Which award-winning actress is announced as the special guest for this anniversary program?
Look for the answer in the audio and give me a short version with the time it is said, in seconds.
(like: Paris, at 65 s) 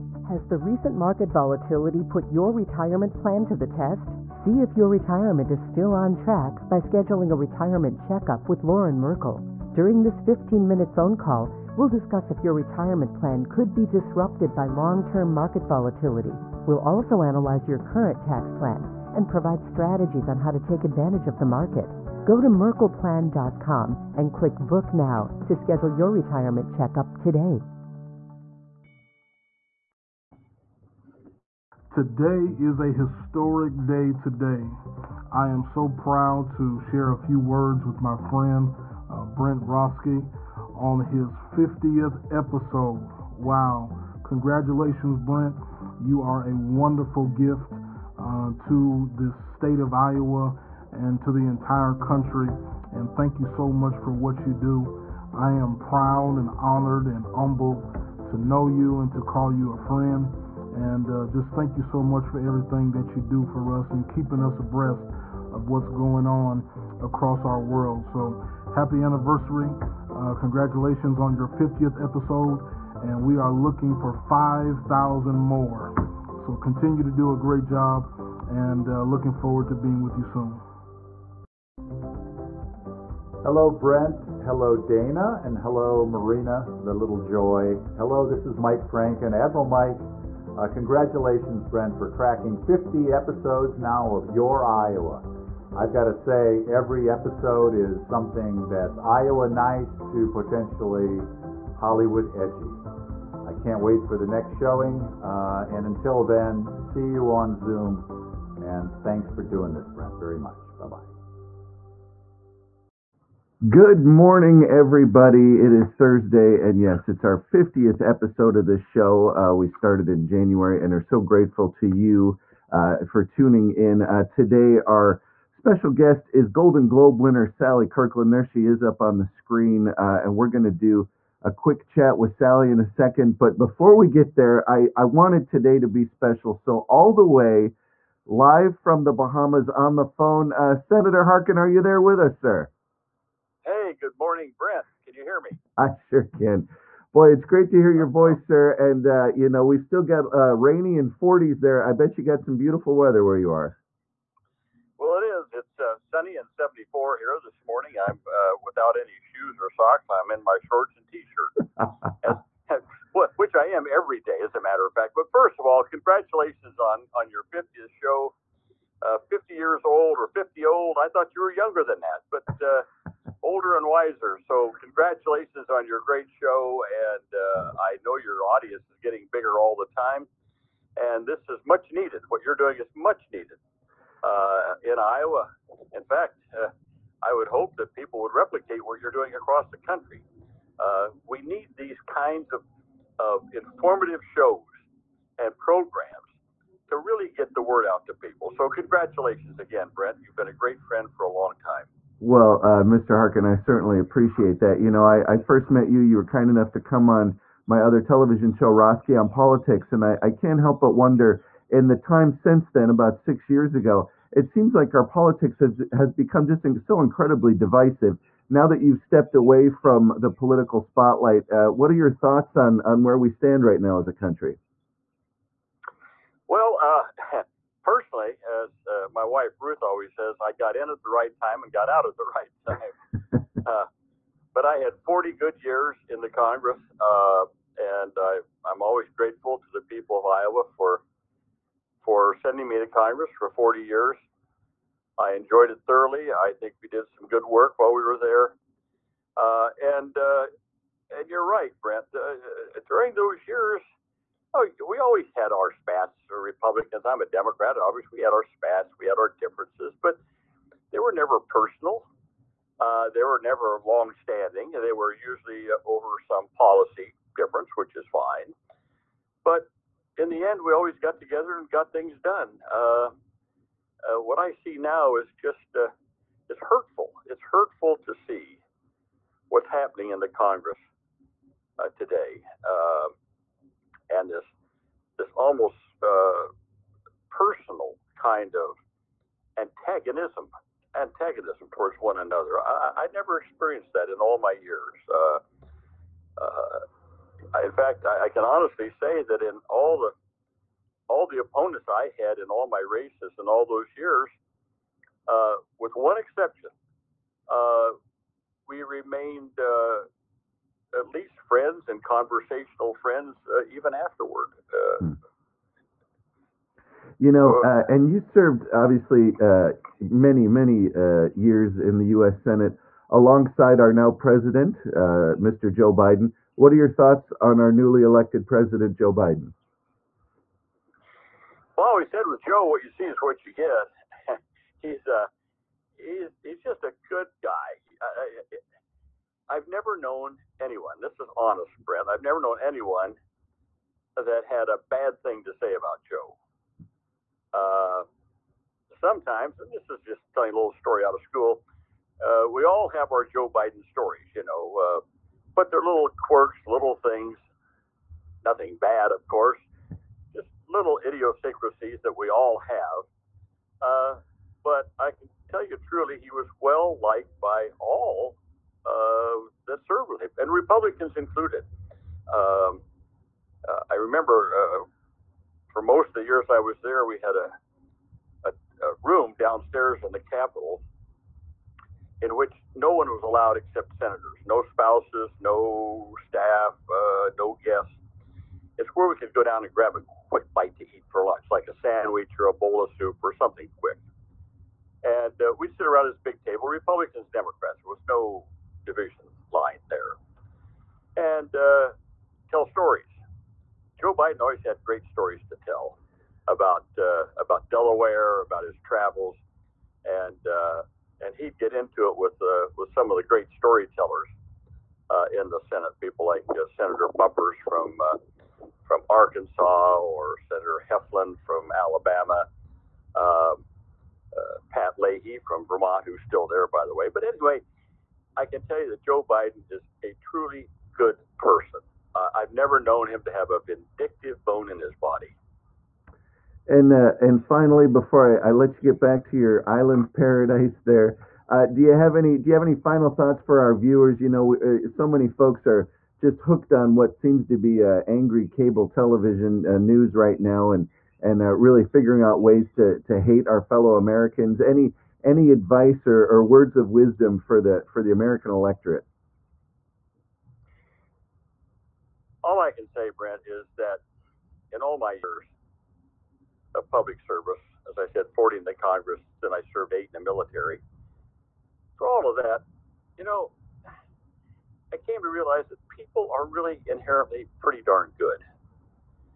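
Sally Kirkland, at 127 s.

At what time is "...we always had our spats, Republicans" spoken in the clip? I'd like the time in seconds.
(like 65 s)
254 s.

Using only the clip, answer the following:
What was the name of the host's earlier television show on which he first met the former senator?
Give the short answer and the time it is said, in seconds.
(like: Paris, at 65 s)
Roske on Politics, at 208 s.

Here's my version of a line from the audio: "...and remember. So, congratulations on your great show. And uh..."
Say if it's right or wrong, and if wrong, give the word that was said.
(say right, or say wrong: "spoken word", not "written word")
wrong: "wiser", not "remember".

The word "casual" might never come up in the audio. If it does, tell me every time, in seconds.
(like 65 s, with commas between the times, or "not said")
not said.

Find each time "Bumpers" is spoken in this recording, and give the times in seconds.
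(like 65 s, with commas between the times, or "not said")
417 s.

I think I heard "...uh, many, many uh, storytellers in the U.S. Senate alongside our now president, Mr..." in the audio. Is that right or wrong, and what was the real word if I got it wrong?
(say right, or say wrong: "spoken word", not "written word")
wrong: "years", not "storytellers".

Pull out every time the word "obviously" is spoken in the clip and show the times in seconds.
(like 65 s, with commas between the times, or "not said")
257 s, 318 s.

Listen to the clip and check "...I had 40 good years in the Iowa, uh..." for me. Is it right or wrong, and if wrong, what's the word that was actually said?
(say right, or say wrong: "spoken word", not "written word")
wrong: "Congress", not "Iowa".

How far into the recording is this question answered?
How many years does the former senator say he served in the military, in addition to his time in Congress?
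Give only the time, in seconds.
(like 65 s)
469 s.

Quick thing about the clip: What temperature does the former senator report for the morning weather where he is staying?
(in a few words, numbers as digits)
74.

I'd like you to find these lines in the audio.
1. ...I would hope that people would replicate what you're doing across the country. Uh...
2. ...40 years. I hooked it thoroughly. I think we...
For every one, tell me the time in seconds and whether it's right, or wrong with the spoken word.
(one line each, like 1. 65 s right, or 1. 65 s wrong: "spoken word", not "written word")
1. 187 s right
2. 243 s wrong: "enjoyed", not "hooked".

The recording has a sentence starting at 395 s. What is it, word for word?
And uh, we'd sit around this big table, Republicans, Democrats.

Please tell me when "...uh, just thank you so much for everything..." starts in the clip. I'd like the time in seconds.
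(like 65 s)
61 s.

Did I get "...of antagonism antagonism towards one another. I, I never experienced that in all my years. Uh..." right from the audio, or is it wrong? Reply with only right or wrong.
right.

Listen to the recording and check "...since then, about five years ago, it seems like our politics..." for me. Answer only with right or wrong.
wrong.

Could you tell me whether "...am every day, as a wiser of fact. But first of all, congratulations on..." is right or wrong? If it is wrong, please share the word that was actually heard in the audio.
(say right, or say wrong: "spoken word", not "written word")
wrong: "matter", not "wiser".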